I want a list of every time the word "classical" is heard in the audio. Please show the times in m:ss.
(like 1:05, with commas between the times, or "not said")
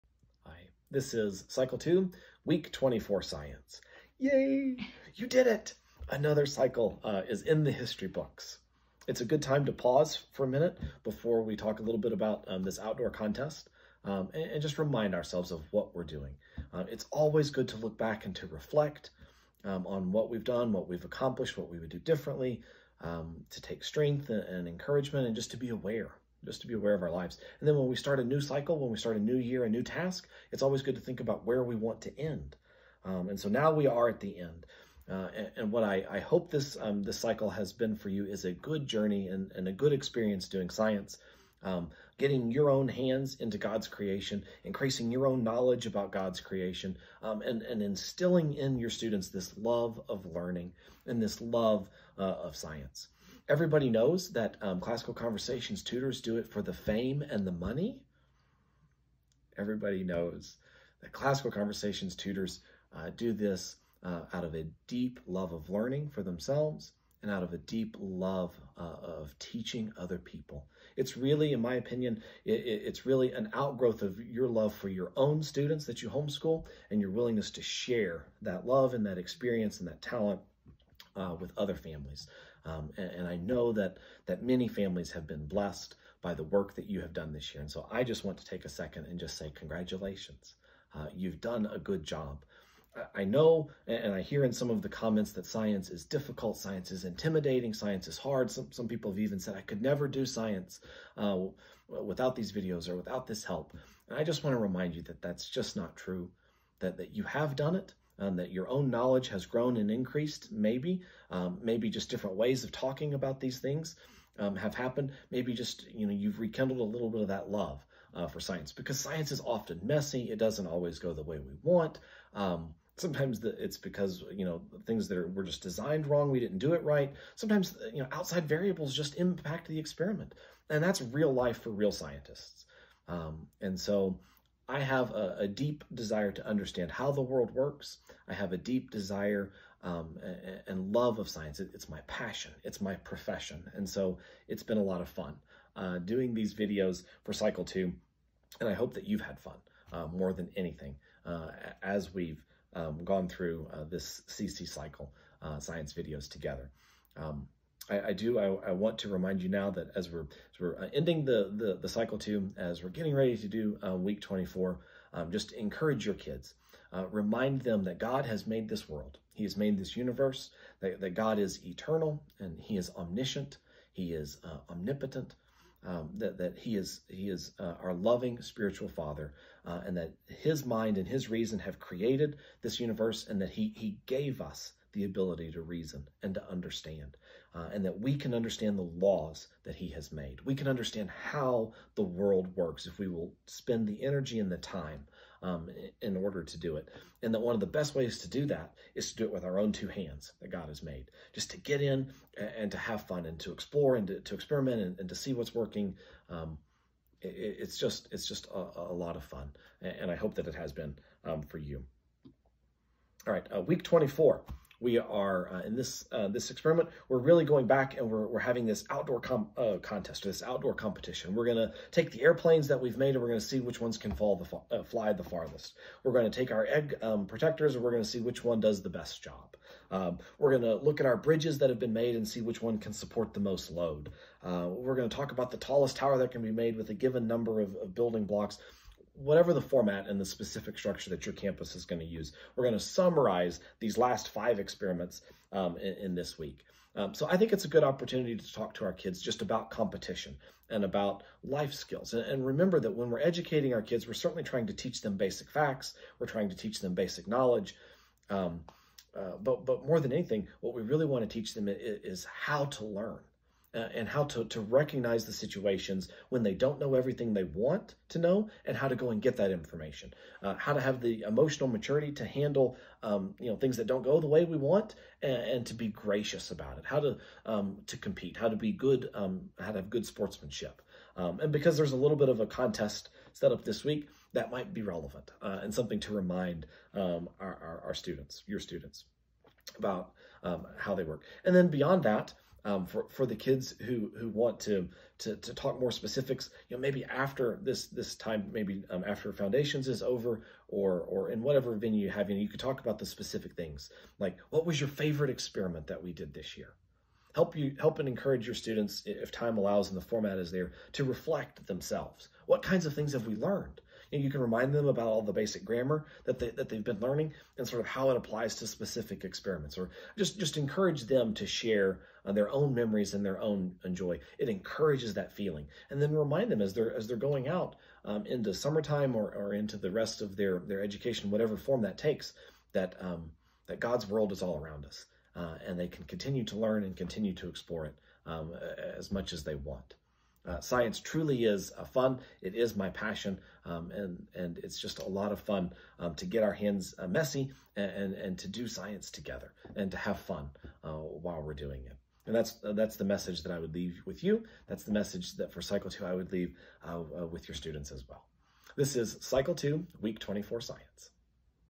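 0:54, 1:01.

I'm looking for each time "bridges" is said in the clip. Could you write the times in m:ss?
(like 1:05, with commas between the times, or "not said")
3:51.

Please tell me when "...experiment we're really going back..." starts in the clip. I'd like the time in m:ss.
3:36.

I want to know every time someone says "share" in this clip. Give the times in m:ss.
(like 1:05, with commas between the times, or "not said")
1:17, 5:21.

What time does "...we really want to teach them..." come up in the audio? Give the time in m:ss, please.
4:20.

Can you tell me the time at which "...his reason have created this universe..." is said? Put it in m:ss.
3:01.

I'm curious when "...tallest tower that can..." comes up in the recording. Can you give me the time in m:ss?
3:55.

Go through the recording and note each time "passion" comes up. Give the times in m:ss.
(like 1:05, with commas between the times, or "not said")
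2:22, 5:42.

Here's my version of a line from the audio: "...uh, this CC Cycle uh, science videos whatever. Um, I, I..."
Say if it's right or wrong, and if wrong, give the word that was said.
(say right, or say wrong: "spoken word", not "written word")
wrong: "together", not "whatever".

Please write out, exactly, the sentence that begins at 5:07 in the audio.
Help you help and encourage your students, if time allows and the format is there, to reflect themselves.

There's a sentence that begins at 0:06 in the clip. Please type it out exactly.
Another cycle uh, is in the history books.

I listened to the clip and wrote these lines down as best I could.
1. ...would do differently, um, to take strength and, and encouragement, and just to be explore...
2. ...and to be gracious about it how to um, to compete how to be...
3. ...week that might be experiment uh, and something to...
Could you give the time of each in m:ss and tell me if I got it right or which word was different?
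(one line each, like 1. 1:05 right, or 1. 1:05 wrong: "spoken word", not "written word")
1. 0:21 wrong: "aware", not "explore"
2. 4:35 right
3. 4:43 wrong: "relevant", not "experiment".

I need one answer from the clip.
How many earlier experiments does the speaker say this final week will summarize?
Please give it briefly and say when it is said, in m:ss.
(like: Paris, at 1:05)
5, at 4:04.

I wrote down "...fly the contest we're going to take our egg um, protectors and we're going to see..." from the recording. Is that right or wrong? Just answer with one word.
wrong.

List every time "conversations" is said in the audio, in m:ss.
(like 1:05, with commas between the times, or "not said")
0:55, 1:01.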